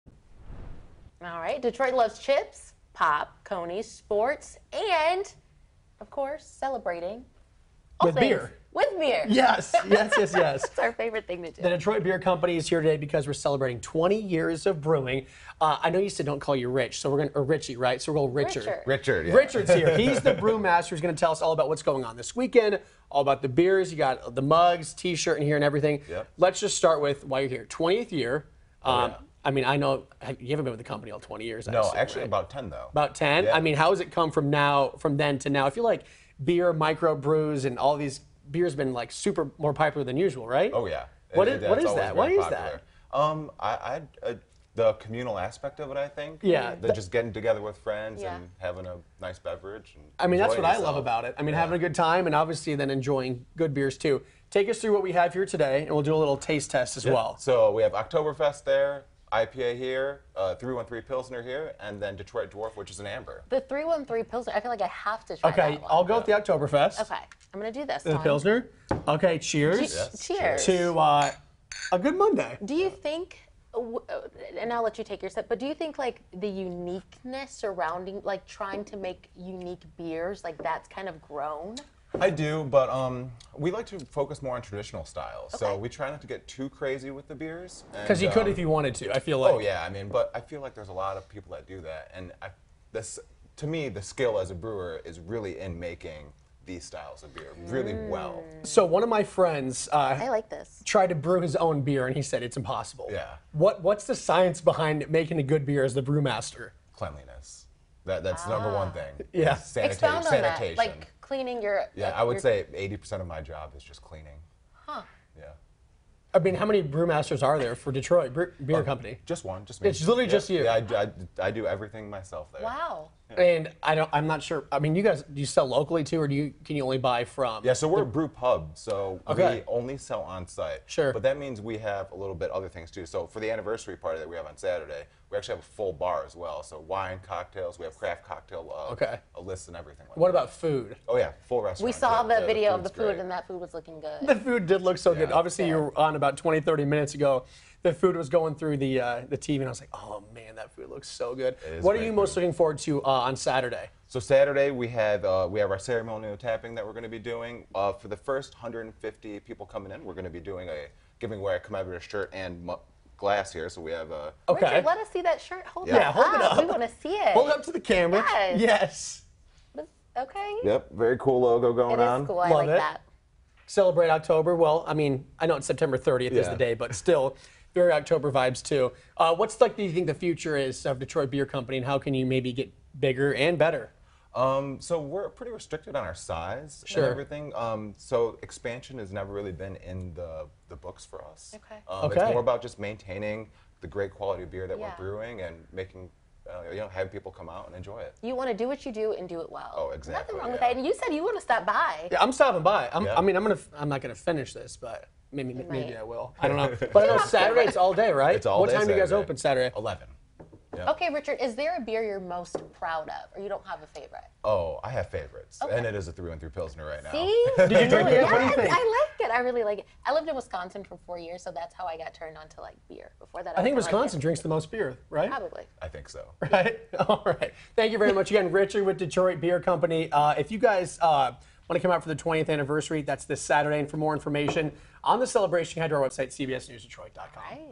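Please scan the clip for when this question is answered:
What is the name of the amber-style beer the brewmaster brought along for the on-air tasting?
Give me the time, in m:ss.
1:02.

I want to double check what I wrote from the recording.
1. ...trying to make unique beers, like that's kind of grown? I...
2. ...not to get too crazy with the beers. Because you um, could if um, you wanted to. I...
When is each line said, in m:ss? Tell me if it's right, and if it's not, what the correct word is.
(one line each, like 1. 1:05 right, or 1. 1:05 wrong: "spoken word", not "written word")
1. 1:18 right
2. 1:26 right.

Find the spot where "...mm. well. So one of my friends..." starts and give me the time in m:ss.
1:37.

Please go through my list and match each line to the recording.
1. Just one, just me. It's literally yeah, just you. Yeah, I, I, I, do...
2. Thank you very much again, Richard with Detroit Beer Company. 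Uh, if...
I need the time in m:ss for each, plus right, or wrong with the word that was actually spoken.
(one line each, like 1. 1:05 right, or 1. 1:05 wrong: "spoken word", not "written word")
1. 1:59 right
2. 3:47 right.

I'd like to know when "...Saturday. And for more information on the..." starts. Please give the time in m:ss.
3:53.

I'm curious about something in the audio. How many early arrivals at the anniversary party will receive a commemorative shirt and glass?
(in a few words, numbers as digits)
150.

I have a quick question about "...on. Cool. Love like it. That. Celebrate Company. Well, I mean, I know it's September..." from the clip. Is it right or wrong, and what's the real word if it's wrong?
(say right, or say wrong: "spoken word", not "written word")
wrong: "October", not "Company".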